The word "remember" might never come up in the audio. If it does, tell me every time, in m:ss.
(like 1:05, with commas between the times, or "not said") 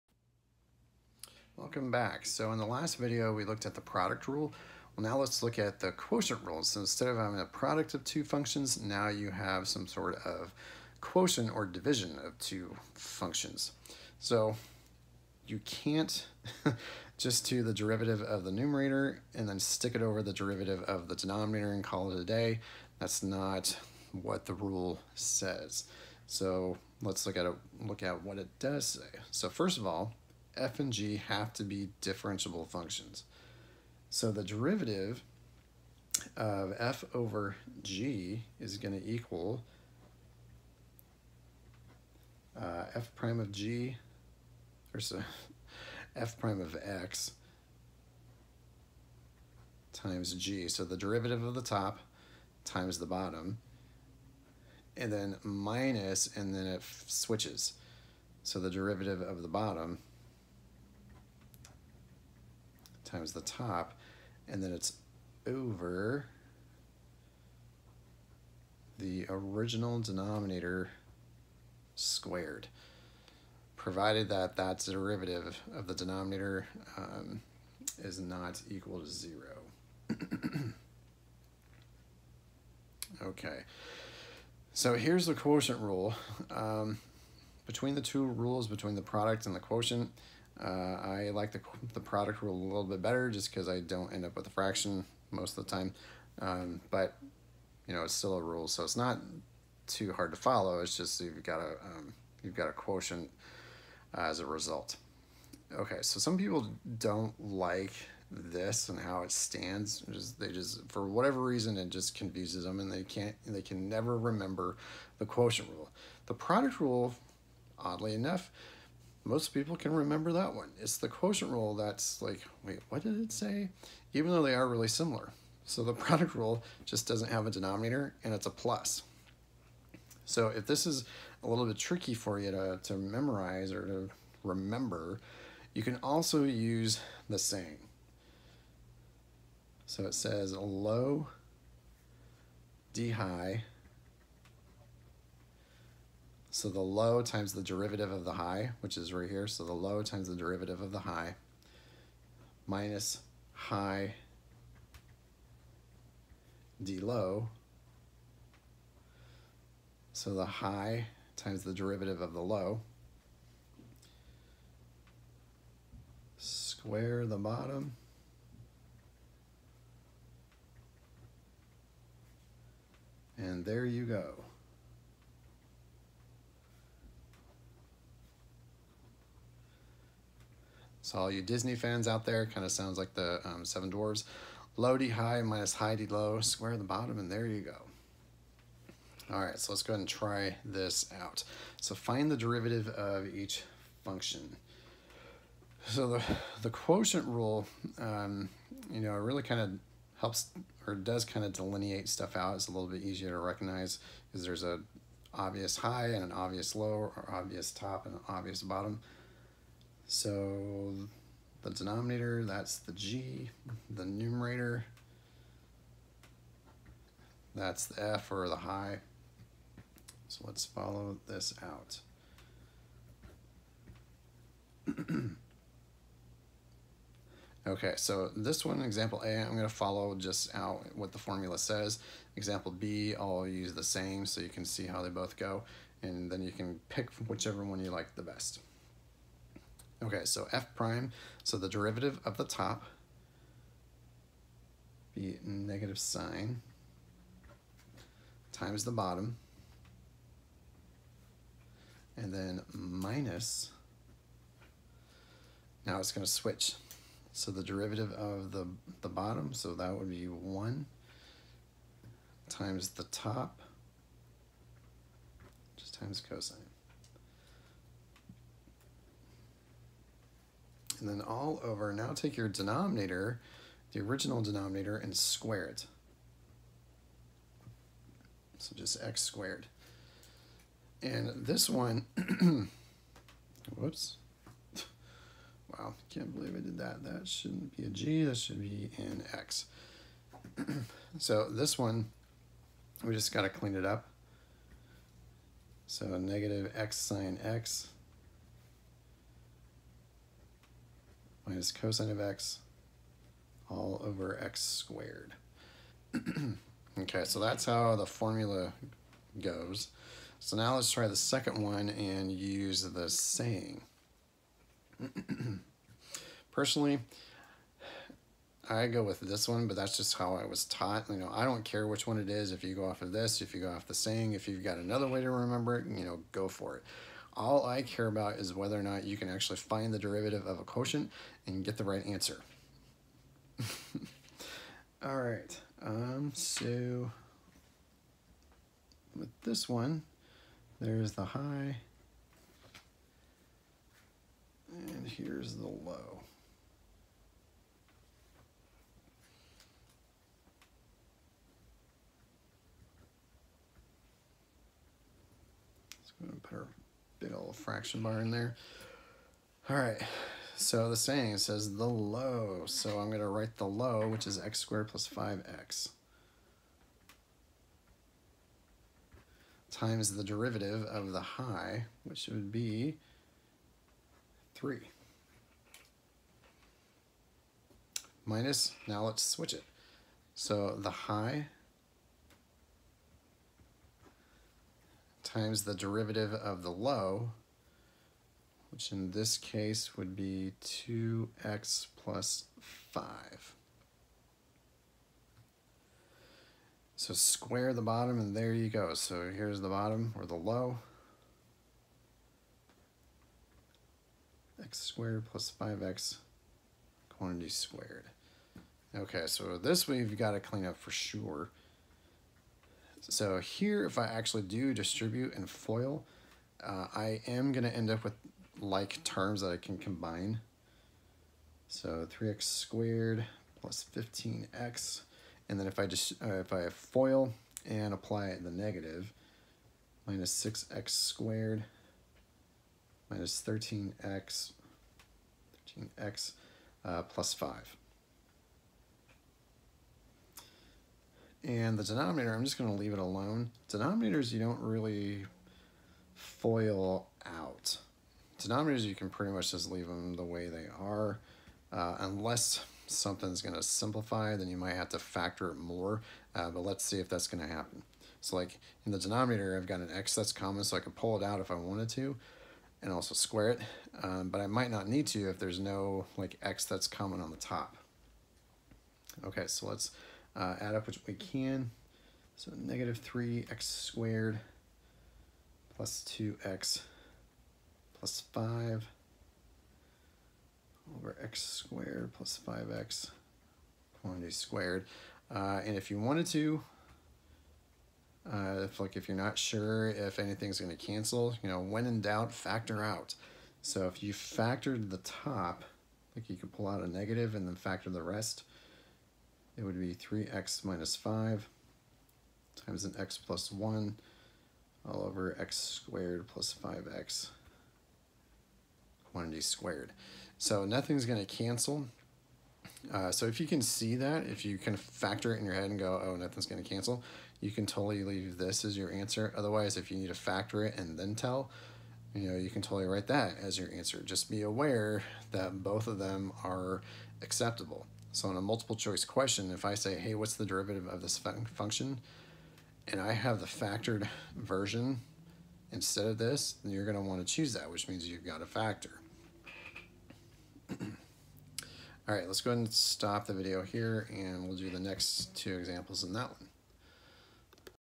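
1:54, 1:59, 2:14, 5:25.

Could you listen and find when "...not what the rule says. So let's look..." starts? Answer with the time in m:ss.
0:23.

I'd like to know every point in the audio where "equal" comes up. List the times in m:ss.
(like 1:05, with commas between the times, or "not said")
0:39, 1:18.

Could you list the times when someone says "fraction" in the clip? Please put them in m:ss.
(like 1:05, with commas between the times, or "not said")
1:34, 5:57.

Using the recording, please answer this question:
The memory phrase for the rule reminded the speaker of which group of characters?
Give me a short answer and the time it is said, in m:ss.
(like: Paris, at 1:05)
Seven Dwarves, at 3:03.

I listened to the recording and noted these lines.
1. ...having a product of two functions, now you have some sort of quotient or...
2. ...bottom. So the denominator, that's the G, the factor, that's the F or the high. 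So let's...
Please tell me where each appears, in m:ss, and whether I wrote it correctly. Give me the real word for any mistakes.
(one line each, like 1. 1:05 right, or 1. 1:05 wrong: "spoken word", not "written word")
1. 0:07 right
2. 3:28 wrong: "numerator", not "factor".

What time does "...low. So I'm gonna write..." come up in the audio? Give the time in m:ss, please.
6:01.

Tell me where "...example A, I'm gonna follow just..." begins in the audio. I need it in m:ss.
3:48.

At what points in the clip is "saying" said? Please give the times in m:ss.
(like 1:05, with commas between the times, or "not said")
5:13, 5:23, 6:00.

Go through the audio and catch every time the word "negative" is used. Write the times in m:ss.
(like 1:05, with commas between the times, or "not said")
4:05, 4:56, 7:08, 7:52, 8:16.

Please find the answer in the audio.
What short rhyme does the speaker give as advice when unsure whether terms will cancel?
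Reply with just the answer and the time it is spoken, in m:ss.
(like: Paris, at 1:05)
when in doubt, factor out, at 8:11.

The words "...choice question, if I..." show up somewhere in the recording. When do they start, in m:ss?
8:48.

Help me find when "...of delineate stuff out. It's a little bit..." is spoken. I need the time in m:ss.
3:21.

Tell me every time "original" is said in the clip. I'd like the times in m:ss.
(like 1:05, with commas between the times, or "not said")
1:09, 4:33.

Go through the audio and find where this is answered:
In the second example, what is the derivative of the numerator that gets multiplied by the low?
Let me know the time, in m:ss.
6:14.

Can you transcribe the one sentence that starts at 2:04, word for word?
Even though they are really similar.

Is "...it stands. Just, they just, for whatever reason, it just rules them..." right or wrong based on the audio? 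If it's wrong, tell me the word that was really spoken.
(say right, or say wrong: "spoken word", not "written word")
wrong: "confuses", not "rules".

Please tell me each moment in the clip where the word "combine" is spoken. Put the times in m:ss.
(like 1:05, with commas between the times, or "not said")
6:59.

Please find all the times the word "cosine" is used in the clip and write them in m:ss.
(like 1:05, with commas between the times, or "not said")
4:26, 5:01.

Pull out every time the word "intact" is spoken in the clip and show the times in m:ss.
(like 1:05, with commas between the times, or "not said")
not said.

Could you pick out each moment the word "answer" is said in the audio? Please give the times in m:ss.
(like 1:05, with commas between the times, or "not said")
5:32, 8:38, 8:43.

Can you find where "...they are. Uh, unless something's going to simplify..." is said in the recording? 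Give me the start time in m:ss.
7:30.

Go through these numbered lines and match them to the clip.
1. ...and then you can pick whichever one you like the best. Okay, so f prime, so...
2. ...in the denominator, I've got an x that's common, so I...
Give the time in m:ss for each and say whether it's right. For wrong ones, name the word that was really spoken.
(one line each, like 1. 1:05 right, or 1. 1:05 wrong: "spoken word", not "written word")
1. 3:56 right
2. 7:38 right.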